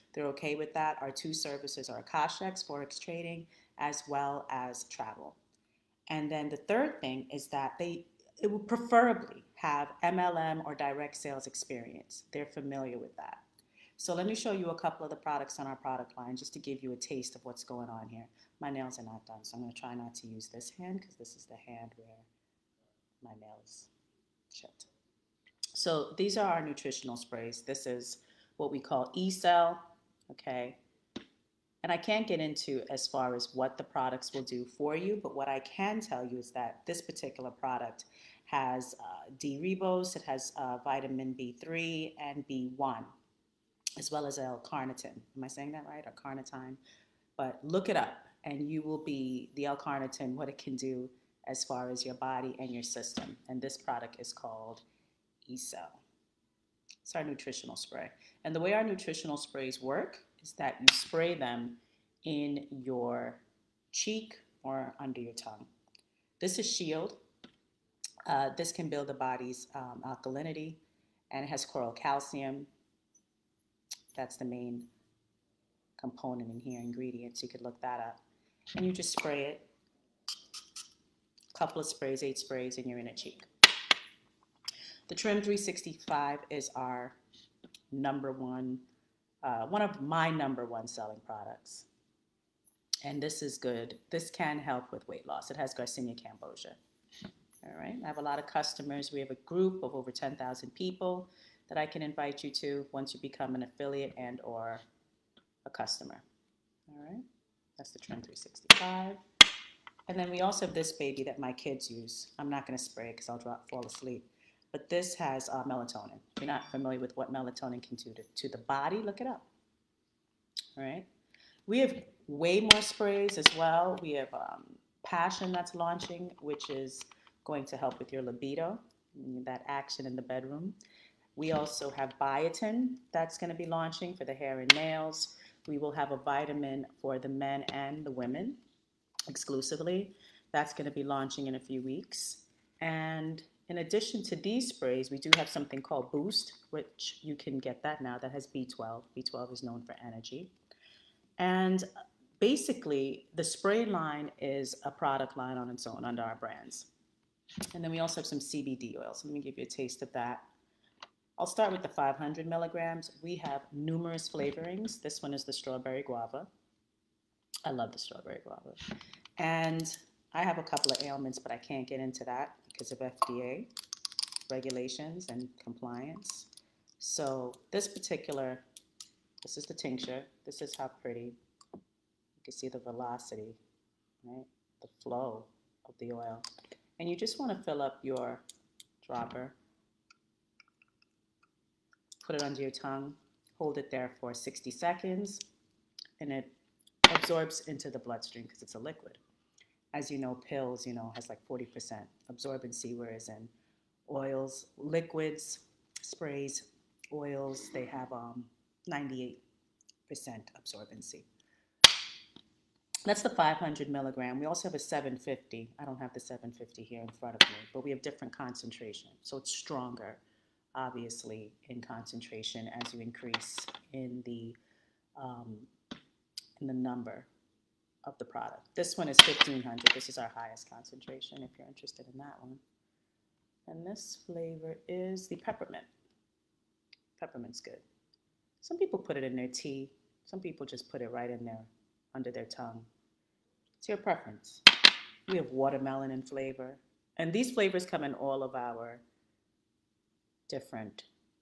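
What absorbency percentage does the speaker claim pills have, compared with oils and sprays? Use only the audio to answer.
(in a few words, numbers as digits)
40%.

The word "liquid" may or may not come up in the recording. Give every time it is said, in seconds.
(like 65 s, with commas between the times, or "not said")
198 s, 204 s.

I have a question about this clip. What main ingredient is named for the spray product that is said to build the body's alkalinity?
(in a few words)
coral calcium.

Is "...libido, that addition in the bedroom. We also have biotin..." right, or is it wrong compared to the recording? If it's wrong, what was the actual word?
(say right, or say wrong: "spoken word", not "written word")
wrong: "action", not "addition".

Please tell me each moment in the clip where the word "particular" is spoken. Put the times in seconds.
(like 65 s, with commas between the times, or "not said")
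37 s, 177 s.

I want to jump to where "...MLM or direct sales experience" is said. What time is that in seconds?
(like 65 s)
10 s.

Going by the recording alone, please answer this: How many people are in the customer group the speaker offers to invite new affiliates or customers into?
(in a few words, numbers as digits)
over 10,000.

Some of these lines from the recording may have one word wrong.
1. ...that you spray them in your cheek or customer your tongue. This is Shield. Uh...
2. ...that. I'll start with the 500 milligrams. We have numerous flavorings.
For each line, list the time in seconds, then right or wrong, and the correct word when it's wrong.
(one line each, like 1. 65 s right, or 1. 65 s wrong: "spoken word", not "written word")
1. 60 s wrong: "under", not "customer"
2. 160 s right.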